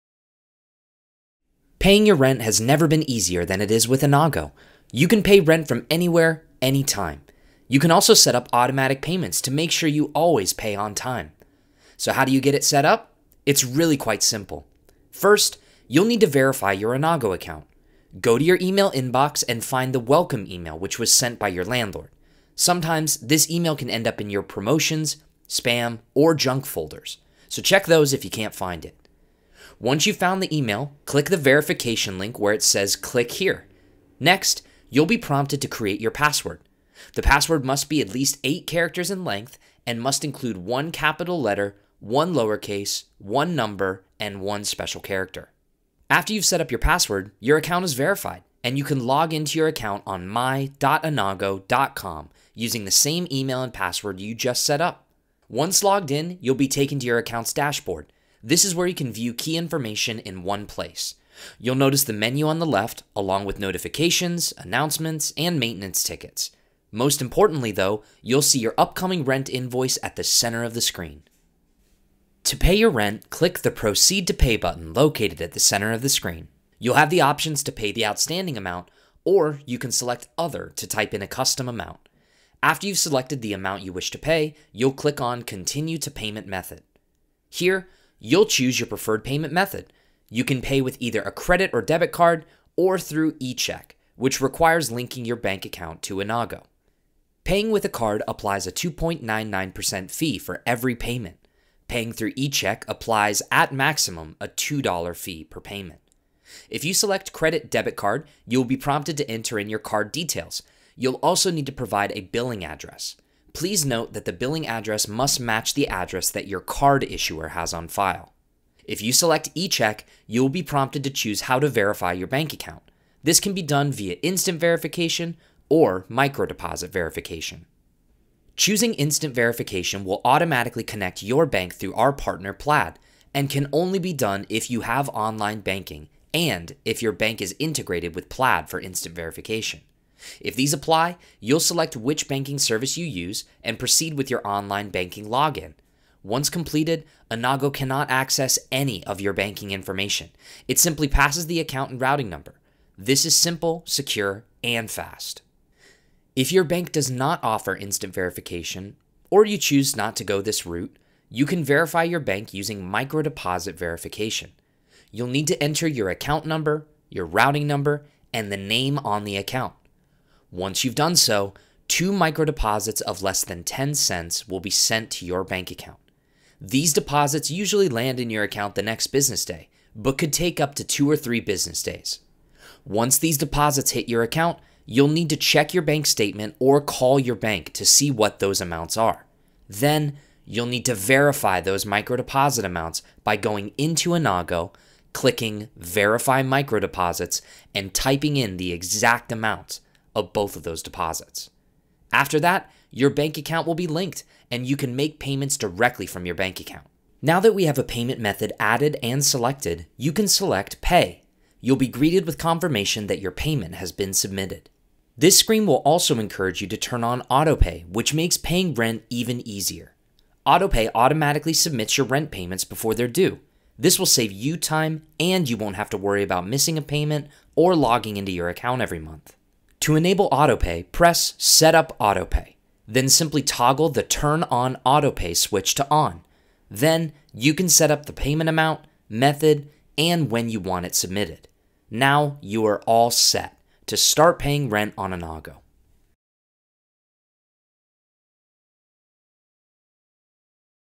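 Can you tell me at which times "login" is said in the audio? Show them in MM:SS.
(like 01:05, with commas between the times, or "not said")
02:25.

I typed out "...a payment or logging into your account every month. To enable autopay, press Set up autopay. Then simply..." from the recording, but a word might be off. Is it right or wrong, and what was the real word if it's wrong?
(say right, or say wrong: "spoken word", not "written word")
right.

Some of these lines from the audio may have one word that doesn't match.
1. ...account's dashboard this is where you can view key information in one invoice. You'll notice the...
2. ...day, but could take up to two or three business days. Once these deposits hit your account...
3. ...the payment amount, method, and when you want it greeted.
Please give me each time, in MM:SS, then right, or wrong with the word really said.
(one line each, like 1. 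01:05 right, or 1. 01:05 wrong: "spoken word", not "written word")
1. 00:57 wrong: "place", not "invoice"
2. 02:59 right
3. 03:58 wrong: "submitted", not "greeted".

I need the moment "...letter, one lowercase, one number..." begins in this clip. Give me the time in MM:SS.
00:41.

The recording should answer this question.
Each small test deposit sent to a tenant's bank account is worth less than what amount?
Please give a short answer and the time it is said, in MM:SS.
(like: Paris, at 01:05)
10 cents, at 02:53.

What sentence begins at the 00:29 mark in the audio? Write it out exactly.
Once you've found the email, click the verification link where it says click here.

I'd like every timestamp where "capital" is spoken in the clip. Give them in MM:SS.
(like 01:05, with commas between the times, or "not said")
00:40.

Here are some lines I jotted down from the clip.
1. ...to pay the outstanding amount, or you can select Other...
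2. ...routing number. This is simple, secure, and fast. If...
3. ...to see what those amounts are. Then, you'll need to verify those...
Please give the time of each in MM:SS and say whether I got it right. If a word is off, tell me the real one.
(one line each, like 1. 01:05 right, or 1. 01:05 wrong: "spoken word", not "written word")
1. 01:17 right
2. 02:32 right
3. 03:07 right.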